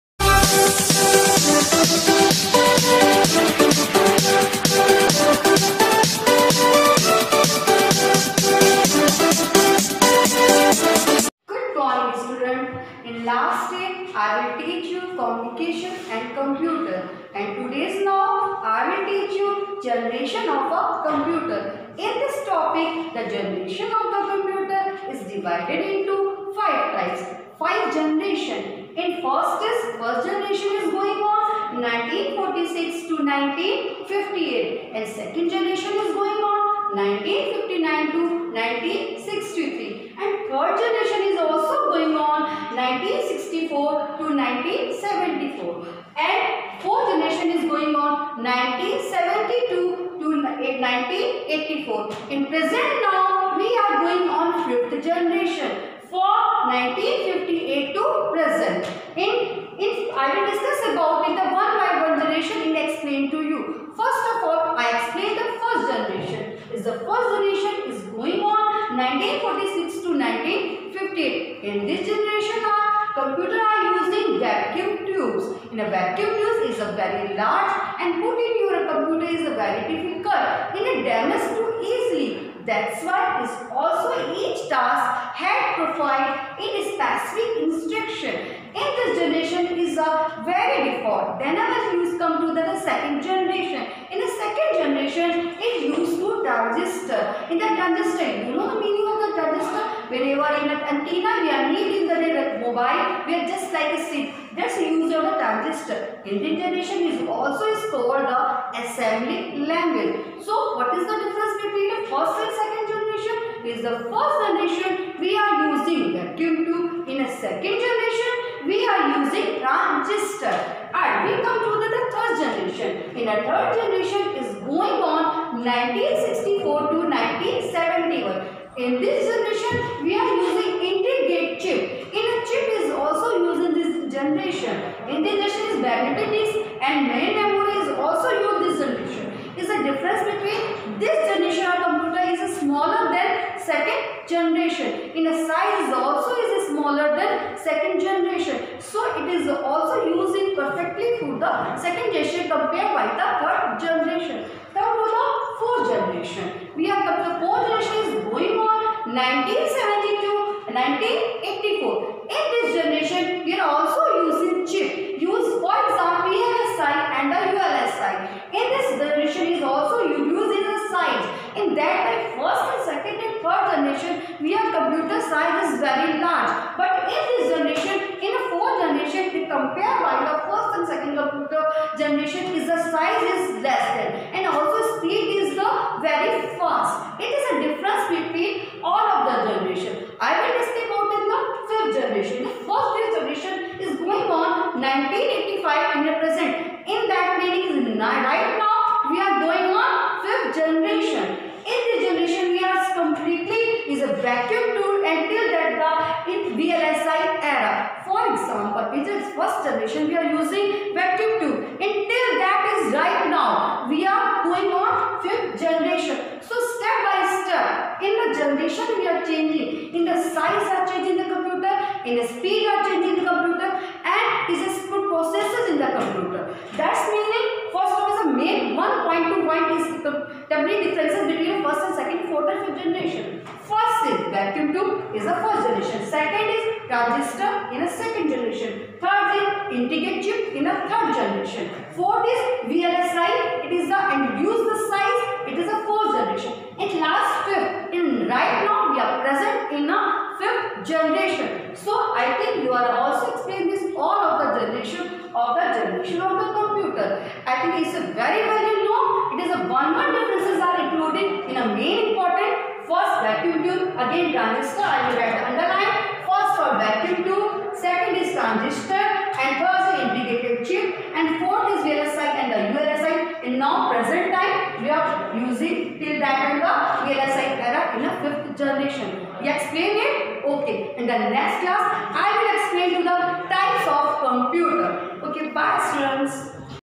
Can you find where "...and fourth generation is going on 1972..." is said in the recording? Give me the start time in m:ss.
0:46.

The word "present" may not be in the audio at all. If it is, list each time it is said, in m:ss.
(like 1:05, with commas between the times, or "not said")
0:52, 0:58, 4:09, 4:33.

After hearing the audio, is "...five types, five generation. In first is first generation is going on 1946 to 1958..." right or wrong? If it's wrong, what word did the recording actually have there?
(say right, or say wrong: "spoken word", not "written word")
right.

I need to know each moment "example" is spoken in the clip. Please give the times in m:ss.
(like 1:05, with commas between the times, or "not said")
2:45.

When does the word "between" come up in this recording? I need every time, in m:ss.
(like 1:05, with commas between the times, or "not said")
1:51, 2:20, 3:51.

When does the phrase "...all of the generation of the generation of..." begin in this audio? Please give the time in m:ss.
4:13.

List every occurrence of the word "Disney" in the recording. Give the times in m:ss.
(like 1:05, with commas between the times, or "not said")
not said.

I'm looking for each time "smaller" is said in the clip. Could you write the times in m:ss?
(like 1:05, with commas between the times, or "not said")
2:22, 2:26.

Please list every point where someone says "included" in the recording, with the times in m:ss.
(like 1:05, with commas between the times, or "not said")
4:20.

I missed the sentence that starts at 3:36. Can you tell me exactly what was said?
So step by step, in the generation we are changing.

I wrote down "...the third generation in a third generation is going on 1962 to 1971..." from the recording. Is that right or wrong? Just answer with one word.
wrong.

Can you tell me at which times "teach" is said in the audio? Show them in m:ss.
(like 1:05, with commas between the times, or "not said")
0:14, 0:19.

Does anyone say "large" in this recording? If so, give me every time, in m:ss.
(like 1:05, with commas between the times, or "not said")
1:17, 2:56.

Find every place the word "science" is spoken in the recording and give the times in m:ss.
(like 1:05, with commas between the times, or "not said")
2:50, 2:55.